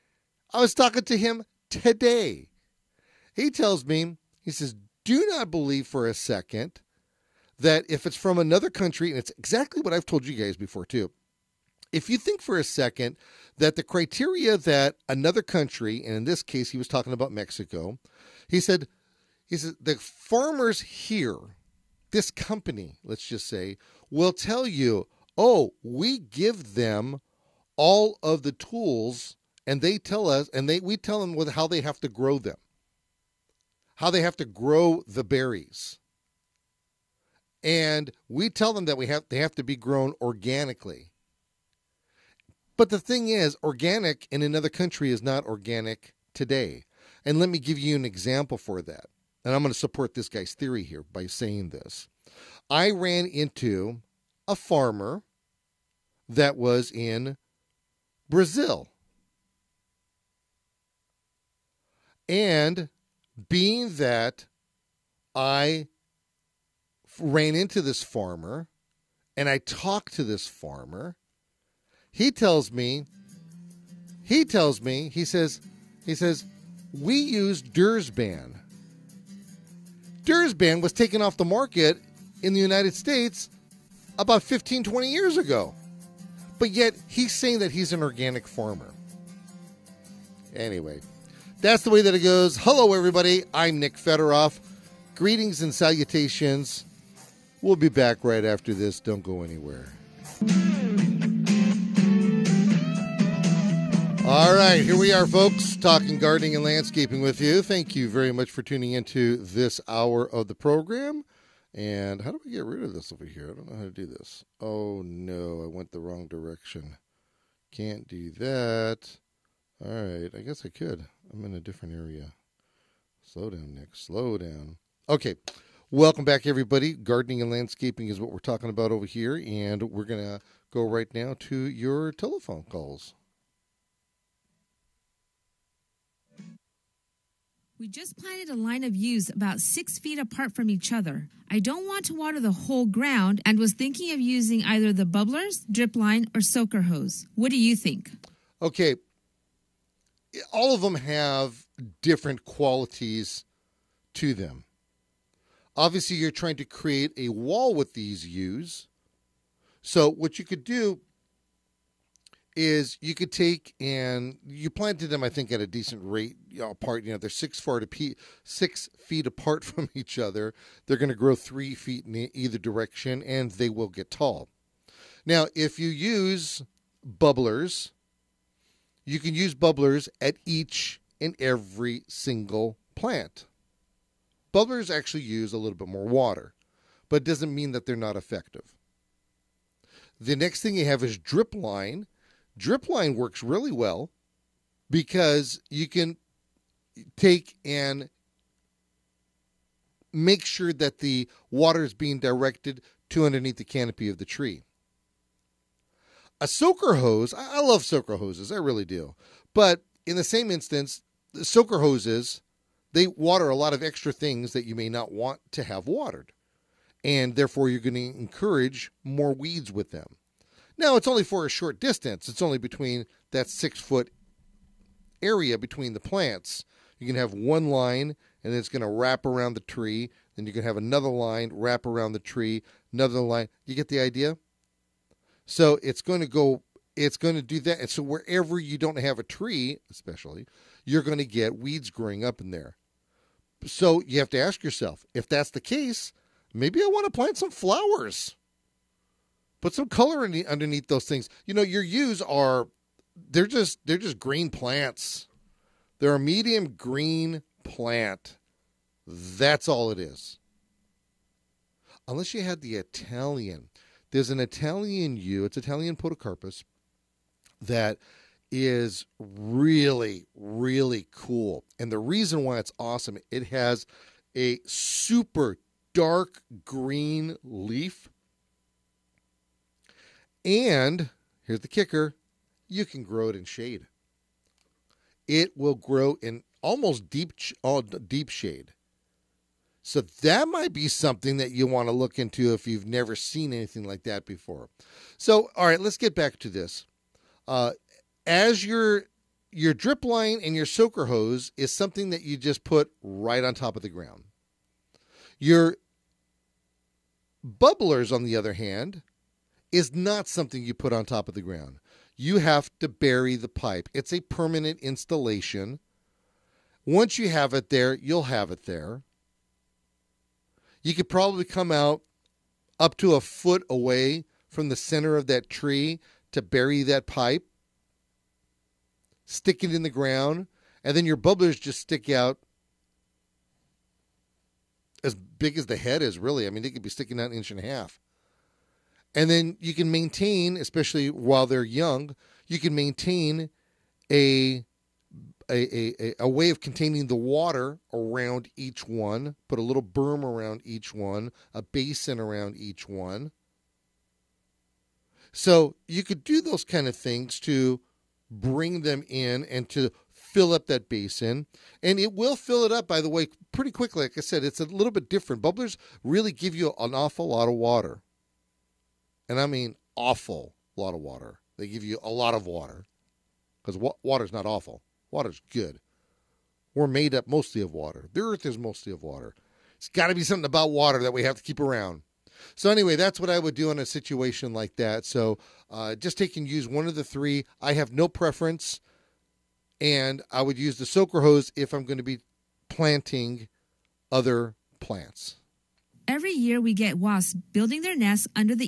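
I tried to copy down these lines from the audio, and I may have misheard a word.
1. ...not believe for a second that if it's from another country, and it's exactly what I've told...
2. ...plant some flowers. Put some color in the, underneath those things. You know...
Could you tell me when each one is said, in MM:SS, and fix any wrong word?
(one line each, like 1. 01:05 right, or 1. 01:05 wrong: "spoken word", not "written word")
1. 00:05 right
2. 04:07 right.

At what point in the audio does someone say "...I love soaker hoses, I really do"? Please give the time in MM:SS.
03:27.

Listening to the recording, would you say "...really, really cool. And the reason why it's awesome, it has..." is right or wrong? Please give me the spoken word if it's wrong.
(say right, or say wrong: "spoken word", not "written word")
right.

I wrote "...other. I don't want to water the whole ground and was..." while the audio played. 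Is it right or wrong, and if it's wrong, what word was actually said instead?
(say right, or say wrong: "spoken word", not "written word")
right.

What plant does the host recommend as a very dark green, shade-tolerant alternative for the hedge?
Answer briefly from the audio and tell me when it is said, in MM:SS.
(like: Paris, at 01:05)
Italian podocarpus, at 04:25.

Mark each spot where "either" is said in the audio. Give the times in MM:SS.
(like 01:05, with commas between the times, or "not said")
02:24, 02:52.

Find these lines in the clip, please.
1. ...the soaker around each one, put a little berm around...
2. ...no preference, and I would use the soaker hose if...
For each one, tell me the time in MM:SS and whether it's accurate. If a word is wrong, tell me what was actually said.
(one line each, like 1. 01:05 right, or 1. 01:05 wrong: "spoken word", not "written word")
1. 05:47 wrong: "water", not "soaker"
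2. 06:27 right.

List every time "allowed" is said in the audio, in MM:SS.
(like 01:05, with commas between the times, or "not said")
not said.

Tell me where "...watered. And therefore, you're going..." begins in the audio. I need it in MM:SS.
03:35.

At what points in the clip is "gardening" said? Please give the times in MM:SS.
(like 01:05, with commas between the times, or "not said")
01:46, 02:06.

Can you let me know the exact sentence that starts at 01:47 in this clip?
Thank you very much for tuning into this hour of the program.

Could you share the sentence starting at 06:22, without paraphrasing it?
So anyway, that's what I would do in a situation like that.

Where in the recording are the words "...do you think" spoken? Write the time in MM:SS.
02:27.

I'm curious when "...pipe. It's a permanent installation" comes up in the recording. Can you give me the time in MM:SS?
05:13.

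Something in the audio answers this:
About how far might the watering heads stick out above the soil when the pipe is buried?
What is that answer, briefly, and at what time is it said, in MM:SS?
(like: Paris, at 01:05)
1.5 inches, at 05:37.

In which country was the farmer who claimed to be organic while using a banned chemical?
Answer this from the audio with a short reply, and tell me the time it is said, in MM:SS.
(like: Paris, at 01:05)
Brazil, at 00:58.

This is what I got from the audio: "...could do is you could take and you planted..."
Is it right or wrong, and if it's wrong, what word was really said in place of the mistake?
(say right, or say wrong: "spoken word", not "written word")
right.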